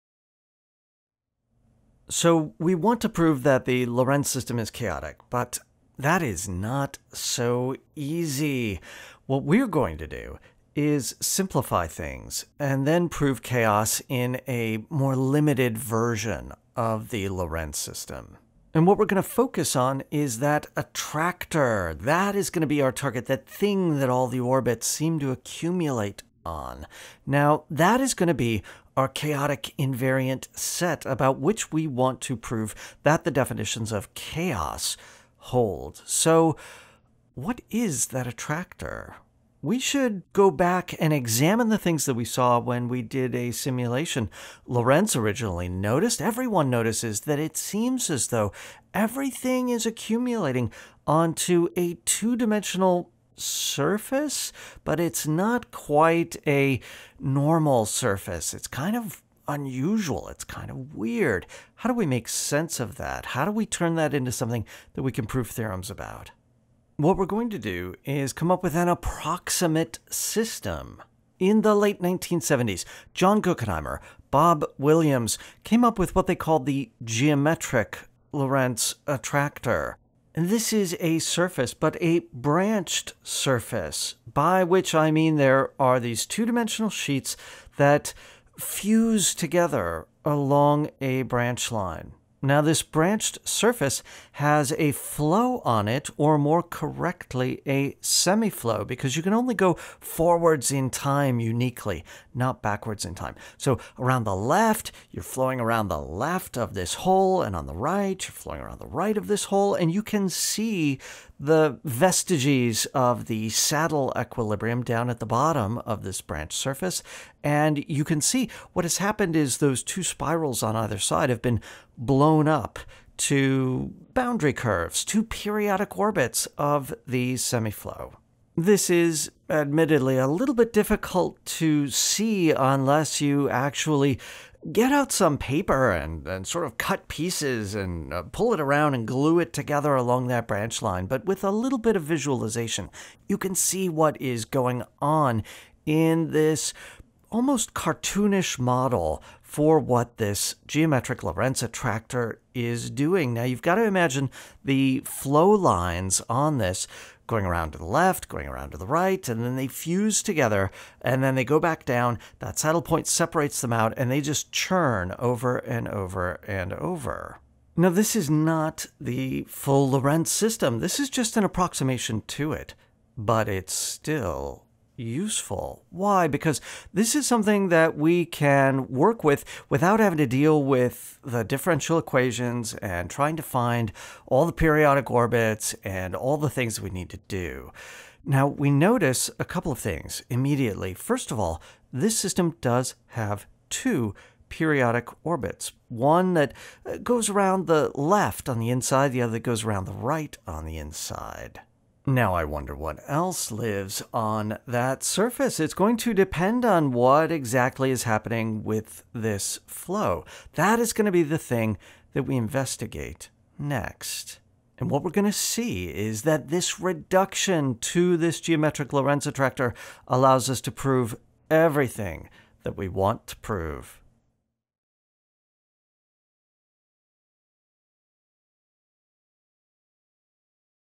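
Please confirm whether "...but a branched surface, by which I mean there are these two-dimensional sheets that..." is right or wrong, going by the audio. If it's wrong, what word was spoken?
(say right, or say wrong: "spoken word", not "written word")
right.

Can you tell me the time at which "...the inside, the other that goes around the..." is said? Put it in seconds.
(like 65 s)
198 s.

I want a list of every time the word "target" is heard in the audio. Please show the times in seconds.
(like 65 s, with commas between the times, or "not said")
22 s.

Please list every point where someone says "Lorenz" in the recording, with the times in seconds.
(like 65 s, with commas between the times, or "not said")
3 s, 17 s, 44 s, 78 s, 151 s, 169 s, 218 s.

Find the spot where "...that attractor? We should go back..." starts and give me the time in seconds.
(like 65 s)
38 s.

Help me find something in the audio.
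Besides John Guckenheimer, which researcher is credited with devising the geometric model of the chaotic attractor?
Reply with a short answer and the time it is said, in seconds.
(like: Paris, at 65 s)
Bob Williams, at 74 s.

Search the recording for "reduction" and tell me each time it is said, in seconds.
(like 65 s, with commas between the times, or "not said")
216 s.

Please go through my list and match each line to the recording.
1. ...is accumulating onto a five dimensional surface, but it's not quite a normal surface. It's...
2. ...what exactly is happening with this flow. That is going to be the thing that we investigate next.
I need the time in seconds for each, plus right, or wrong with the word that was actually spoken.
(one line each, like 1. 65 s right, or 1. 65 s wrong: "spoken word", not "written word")
1. 49 s wrong: "two", not "five"
2. 206 s right.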